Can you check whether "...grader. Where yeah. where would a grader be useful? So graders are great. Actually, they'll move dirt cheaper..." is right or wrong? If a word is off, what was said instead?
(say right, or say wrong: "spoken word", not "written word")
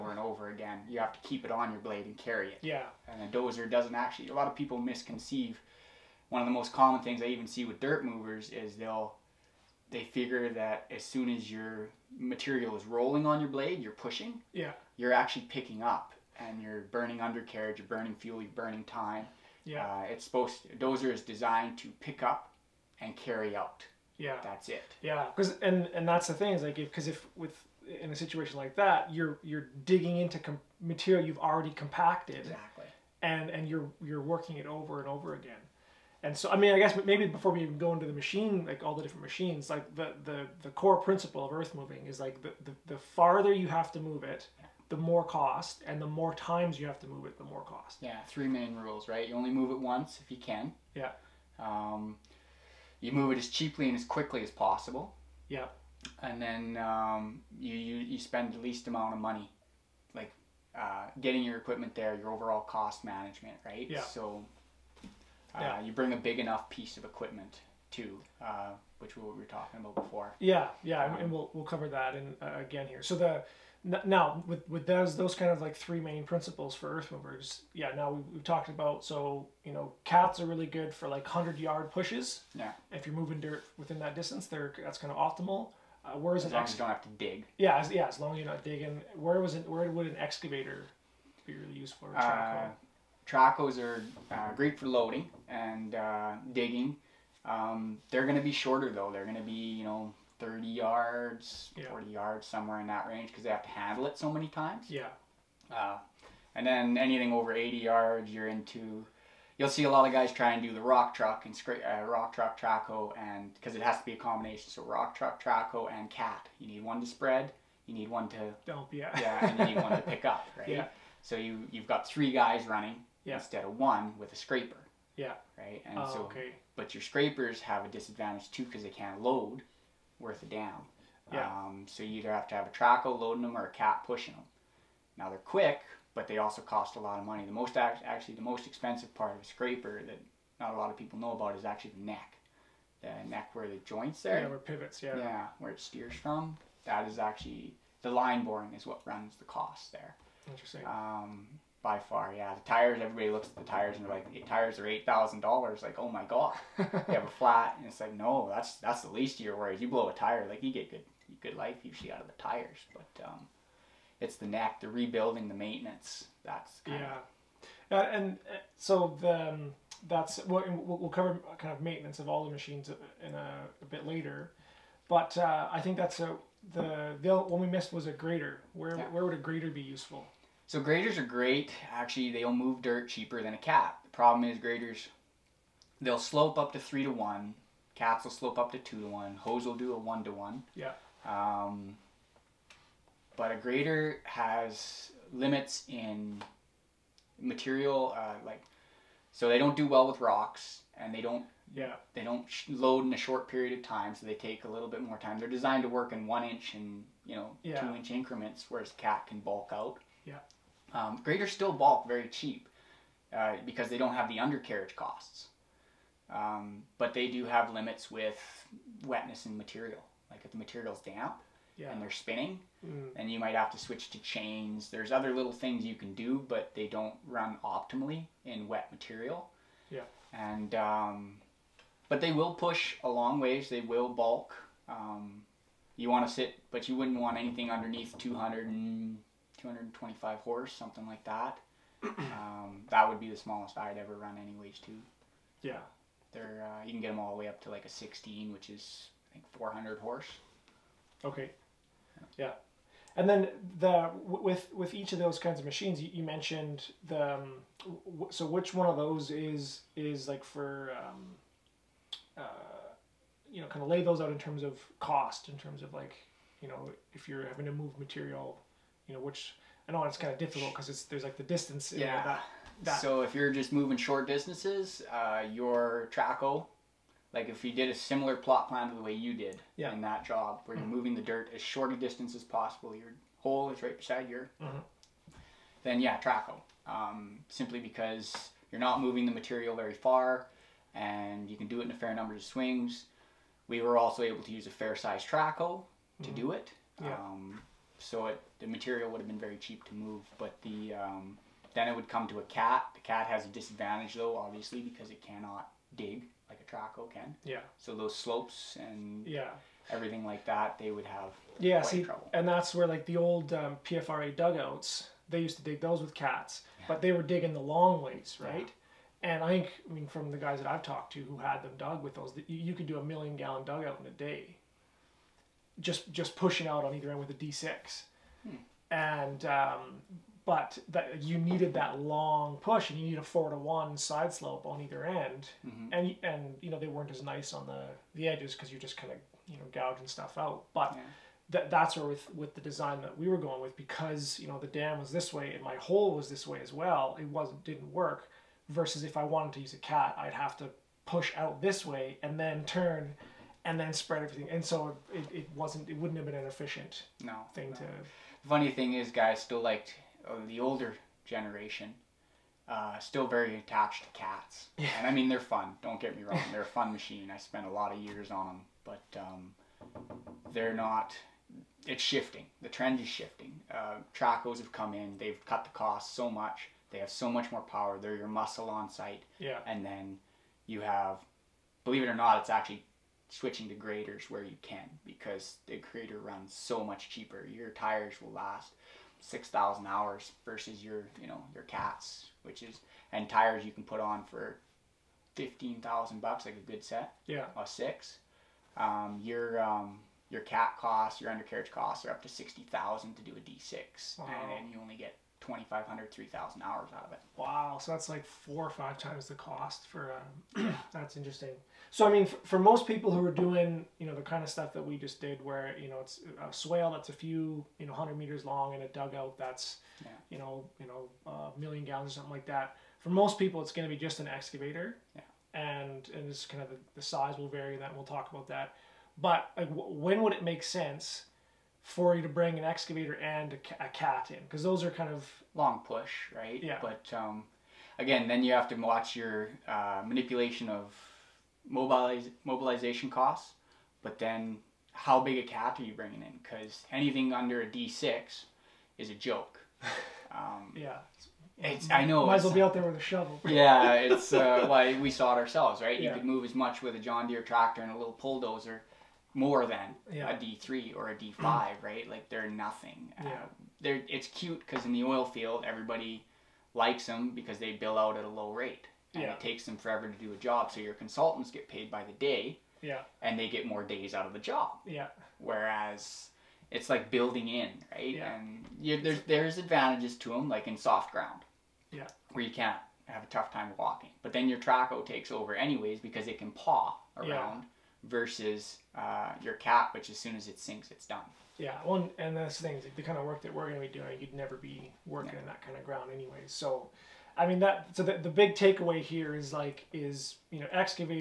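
right.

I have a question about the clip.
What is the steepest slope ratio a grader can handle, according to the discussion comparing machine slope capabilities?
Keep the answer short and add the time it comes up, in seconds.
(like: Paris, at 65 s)
3 to 1, at 186 s.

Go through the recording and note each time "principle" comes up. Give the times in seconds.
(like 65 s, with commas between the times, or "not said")
40 s, 76 s.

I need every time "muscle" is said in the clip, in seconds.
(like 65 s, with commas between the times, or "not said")
378 s.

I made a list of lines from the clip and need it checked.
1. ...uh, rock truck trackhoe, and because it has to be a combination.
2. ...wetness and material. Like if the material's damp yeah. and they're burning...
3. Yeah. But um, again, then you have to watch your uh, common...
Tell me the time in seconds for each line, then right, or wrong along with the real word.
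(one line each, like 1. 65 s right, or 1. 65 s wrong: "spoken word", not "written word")
1. 111 s right
2. 219 s wrong: "spinning", not "burning"
3. 436 s wrong: "manipulation", not "common".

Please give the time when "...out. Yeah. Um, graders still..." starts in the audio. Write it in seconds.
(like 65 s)
209 s.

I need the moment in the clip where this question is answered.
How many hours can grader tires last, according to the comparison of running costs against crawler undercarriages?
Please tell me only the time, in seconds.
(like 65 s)
389 s.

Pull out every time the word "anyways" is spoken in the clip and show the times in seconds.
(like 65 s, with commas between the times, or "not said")
244 s, 485 s, 496 s.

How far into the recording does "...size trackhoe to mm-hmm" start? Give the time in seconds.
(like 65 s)
294 s.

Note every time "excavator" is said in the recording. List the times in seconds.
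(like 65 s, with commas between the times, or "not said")
90 s, 424 s, 432 s.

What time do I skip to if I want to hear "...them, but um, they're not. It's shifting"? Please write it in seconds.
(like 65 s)
368 s.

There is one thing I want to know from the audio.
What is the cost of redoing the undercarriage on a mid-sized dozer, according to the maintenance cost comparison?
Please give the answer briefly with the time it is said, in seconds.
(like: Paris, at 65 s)
$60,000, at 402 s.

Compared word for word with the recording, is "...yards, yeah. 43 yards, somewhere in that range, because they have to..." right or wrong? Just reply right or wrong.
wrong.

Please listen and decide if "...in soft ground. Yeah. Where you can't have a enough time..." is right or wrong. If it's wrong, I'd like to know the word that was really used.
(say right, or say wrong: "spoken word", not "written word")
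wrong: "tough", not "enough".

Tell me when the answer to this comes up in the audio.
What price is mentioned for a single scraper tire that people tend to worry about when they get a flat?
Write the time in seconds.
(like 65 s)
154 s.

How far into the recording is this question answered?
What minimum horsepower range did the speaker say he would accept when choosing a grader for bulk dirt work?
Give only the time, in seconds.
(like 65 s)
238 s.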